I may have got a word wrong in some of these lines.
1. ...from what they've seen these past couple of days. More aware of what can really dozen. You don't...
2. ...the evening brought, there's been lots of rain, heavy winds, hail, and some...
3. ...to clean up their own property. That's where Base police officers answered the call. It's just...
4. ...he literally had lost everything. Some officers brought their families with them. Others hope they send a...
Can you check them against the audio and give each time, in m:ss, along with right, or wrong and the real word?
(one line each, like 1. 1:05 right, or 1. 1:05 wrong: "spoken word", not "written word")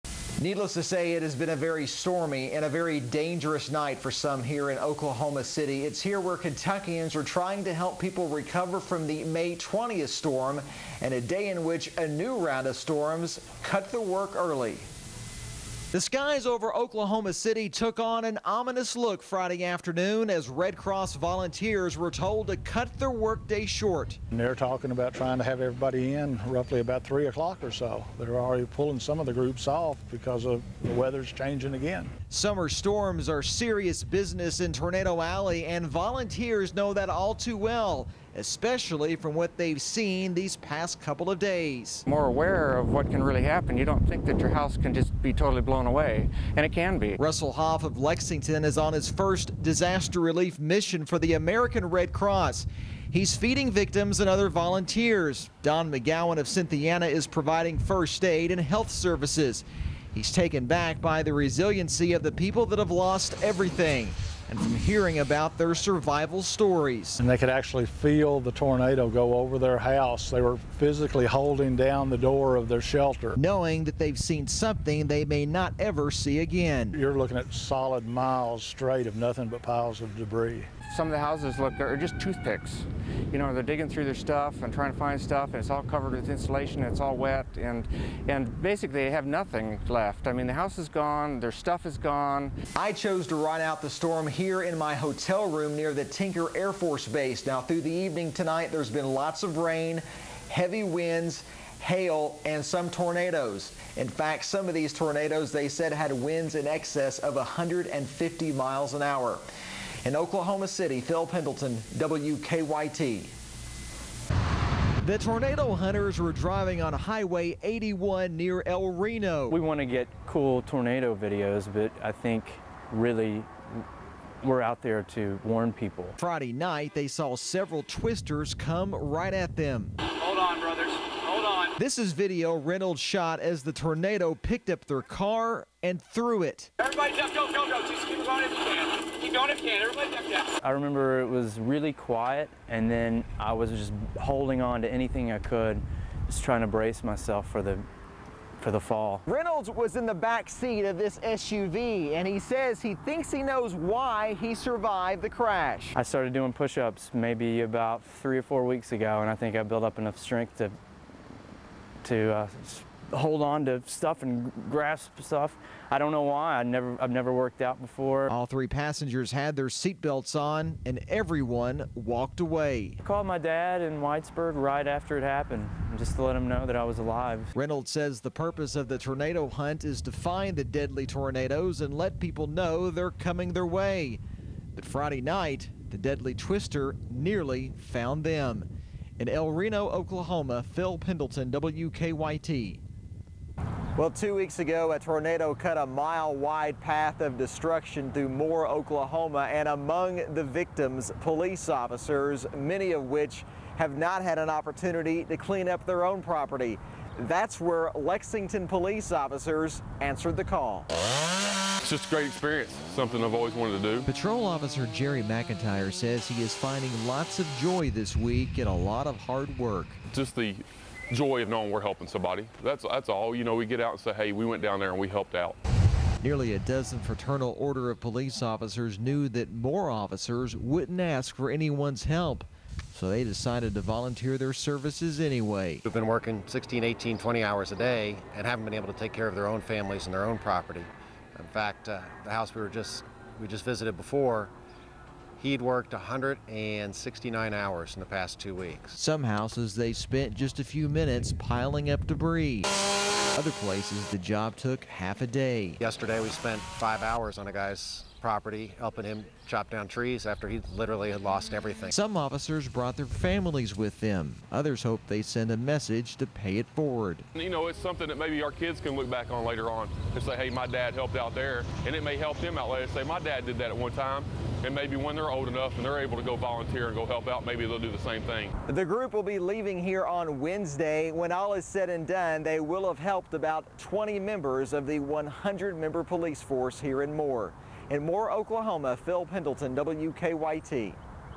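1. 0:39 wrong: "happen", not "dozen"
2. 1:37 wrong: "tonight", not "brought"
3. 3:25 wrong: "Lexington", not "Base"
4. 4:20 right.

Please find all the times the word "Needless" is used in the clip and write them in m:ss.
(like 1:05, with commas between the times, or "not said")
0:00.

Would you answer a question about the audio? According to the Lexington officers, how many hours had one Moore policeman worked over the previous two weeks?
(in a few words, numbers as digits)
169.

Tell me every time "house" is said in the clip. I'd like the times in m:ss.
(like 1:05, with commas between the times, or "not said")
0:44, 1:09, 1:21, 1:30, 4:02, 4:09.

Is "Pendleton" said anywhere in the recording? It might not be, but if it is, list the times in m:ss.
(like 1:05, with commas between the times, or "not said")
1:51, 3:10, 4:49.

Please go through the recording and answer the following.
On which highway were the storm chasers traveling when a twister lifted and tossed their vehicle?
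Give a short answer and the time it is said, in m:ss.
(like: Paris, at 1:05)
Highway 81, at 1:56.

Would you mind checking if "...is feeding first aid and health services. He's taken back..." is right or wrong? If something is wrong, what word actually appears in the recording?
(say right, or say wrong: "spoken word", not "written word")
wrong: "providing", not "feeding".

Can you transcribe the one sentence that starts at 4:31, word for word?
And it may help them out later say, my dad did that at one time.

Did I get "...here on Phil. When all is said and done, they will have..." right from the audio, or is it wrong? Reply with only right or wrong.
wrong.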